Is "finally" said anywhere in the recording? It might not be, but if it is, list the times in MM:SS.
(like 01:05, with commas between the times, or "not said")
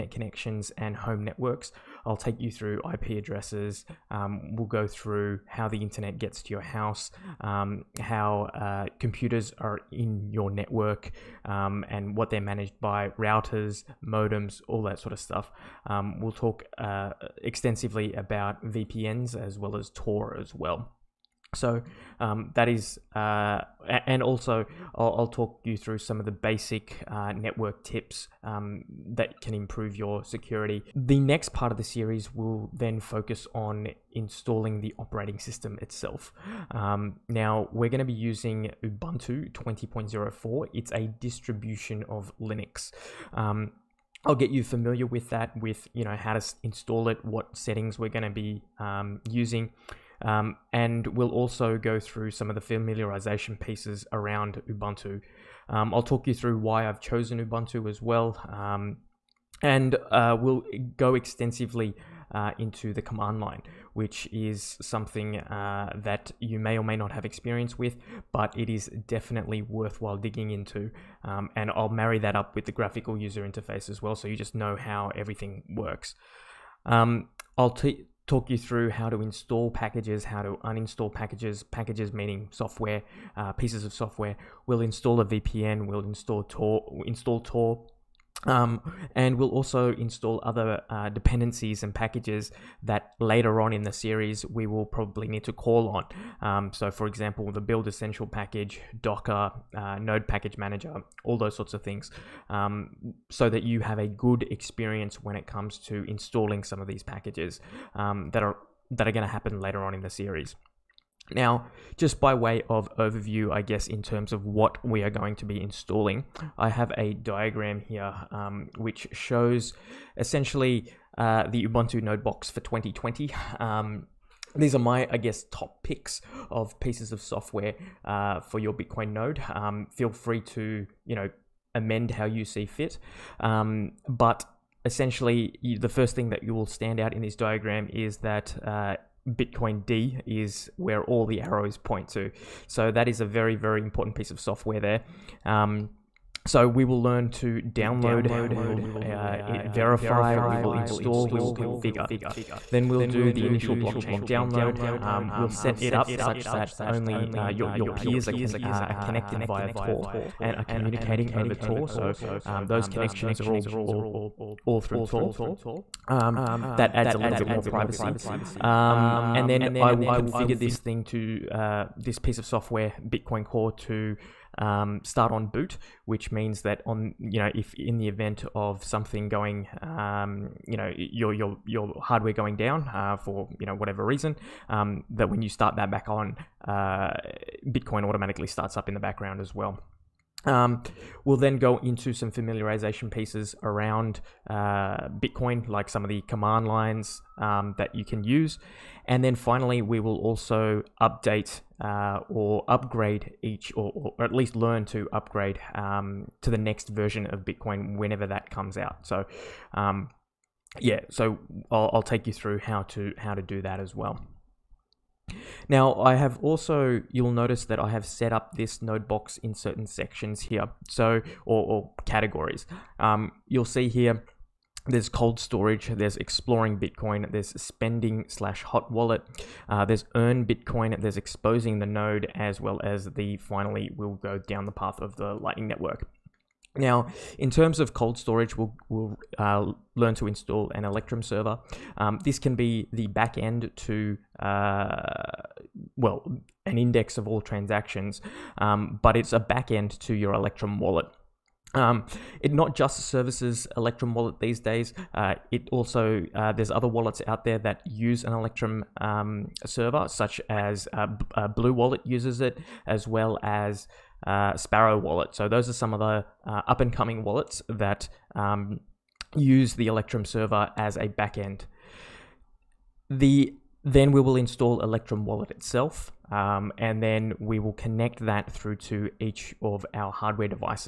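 03:19, 03:53.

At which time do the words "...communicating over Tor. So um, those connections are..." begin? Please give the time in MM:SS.
02:40.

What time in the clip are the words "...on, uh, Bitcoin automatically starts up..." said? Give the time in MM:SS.
03:06.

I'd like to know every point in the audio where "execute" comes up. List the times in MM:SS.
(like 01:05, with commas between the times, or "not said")
not said.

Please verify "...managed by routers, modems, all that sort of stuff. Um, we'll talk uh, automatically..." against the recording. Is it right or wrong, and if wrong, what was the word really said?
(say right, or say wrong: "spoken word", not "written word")
wrong: "extensively", not "automatically".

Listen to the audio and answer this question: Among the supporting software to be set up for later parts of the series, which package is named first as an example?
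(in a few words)
Build Essential.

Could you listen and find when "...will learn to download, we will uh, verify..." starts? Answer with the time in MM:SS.
02:26.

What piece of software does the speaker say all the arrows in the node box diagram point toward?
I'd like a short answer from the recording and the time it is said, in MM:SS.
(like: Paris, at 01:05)
bitcoind, at 02:19.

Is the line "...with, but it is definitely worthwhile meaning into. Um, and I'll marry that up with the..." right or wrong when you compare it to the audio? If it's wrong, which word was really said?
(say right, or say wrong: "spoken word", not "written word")
wrong: "digging", not "meaning".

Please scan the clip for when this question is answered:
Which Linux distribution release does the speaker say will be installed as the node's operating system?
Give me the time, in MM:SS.
00:38.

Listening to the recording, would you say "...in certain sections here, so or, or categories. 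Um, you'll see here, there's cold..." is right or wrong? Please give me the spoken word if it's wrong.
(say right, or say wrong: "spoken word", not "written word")
right.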